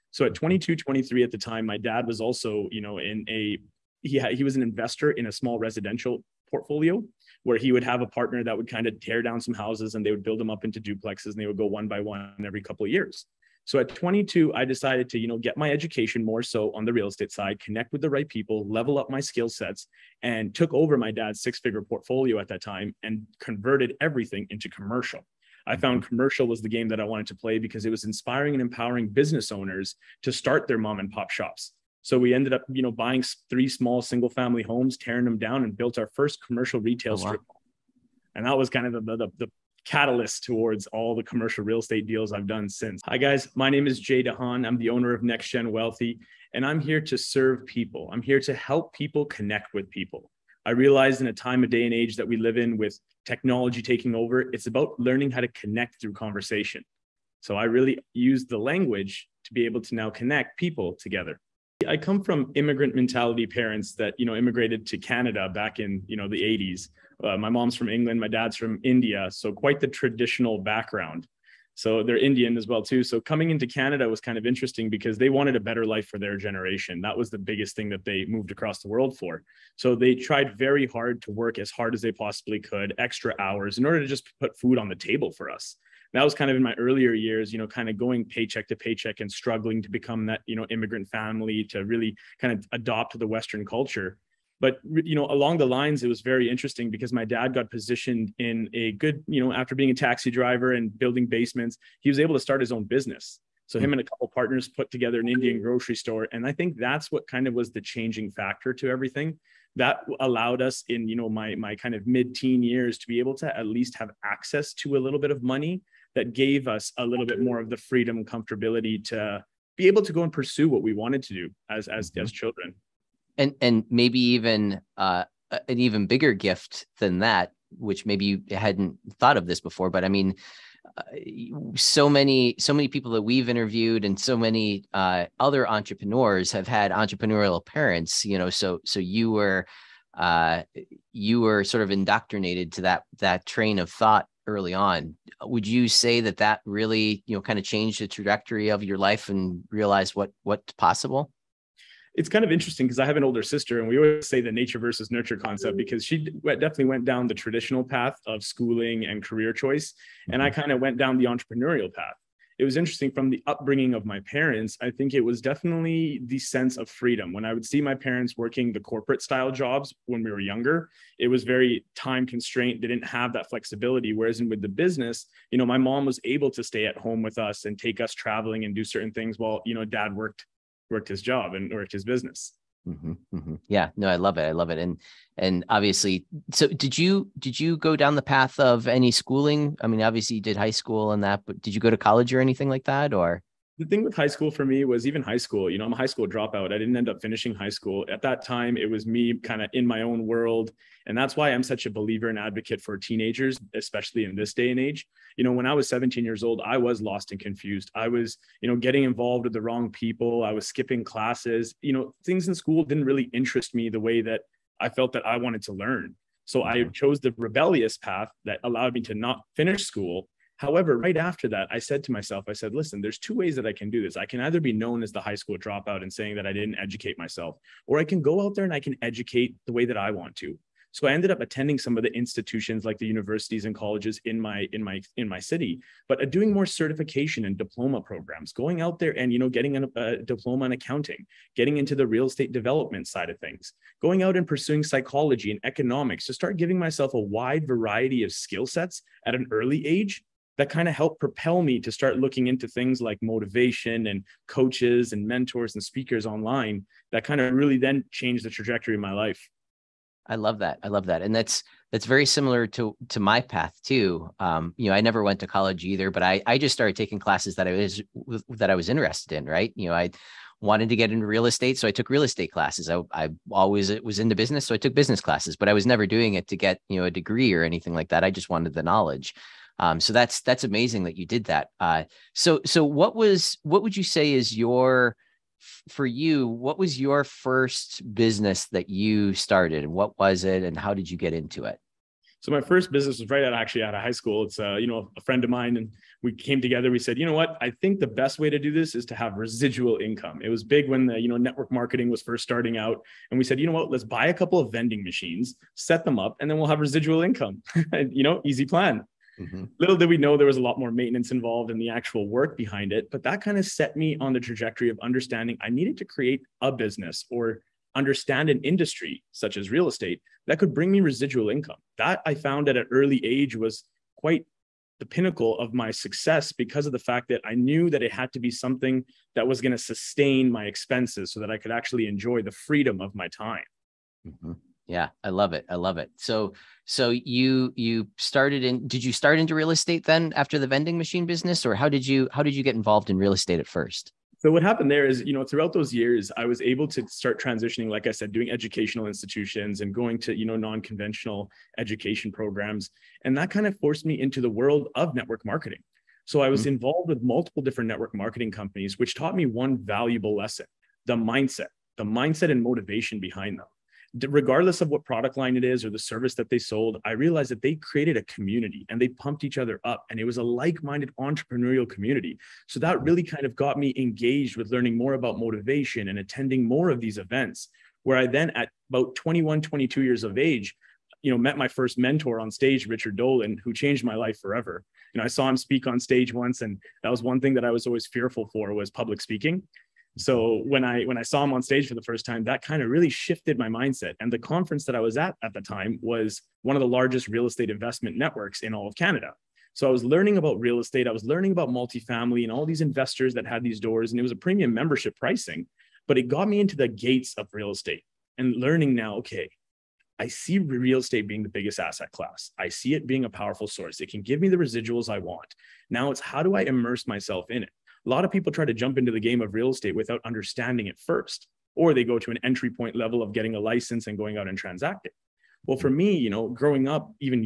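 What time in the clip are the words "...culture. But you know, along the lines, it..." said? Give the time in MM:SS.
01:33.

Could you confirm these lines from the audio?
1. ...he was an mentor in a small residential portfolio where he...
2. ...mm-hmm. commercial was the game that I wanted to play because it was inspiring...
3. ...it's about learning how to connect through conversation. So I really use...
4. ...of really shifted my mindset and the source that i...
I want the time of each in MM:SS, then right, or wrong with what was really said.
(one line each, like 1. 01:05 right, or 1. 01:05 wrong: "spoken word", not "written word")
1. 00:04 wrong: "investor", not "mentor"
2. 00:26 right
3. 00:54 right
4. 06:32 wrong: "conference", not "source".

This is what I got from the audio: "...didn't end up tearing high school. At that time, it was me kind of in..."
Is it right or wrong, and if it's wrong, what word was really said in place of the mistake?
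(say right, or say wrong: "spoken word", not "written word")
wrong: "finishing", not "tearing".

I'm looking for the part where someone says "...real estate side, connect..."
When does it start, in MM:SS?
00:16.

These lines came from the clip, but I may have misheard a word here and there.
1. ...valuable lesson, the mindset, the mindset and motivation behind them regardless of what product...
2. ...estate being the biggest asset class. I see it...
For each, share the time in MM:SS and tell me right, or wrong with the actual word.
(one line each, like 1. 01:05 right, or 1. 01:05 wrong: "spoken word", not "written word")
1. 05:59 right
2. 06:50 right.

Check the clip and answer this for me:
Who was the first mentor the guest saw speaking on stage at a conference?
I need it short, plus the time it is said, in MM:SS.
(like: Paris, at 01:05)
Richard Dolan, at 06:22.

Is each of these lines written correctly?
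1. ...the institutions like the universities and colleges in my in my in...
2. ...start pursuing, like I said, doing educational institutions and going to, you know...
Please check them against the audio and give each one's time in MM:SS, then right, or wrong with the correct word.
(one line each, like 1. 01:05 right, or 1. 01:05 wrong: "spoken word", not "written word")
1. 03:52 right
2. 05:47 wrong: "transitioning", not "pursuing".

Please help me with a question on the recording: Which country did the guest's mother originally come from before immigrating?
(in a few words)
England.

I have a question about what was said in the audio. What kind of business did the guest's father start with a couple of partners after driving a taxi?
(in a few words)
Indian grocery store.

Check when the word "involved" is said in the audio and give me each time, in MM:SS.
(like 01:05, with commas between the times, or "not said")
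03:29, 05:11, 05:42, 05:56.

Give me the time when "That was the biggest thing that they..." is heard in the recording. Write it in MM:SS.
01:17.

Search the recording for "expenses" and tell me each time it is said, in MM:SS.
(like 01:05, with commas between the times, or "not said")
05:30.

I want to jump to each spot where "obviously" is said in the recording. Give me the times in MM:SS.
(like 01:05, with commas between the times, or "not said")
03:05, 03:10.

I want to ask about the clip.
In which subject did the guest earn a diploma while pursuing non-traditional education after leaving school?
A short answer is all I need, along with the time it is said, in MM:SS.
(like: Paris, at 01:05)
accounting, at 04:00.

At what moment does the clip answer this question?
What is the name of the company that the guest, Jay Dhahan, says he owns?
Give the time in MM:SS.
00:45.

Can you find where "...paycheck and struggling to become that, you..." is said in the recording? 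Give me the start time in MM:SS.
01:28.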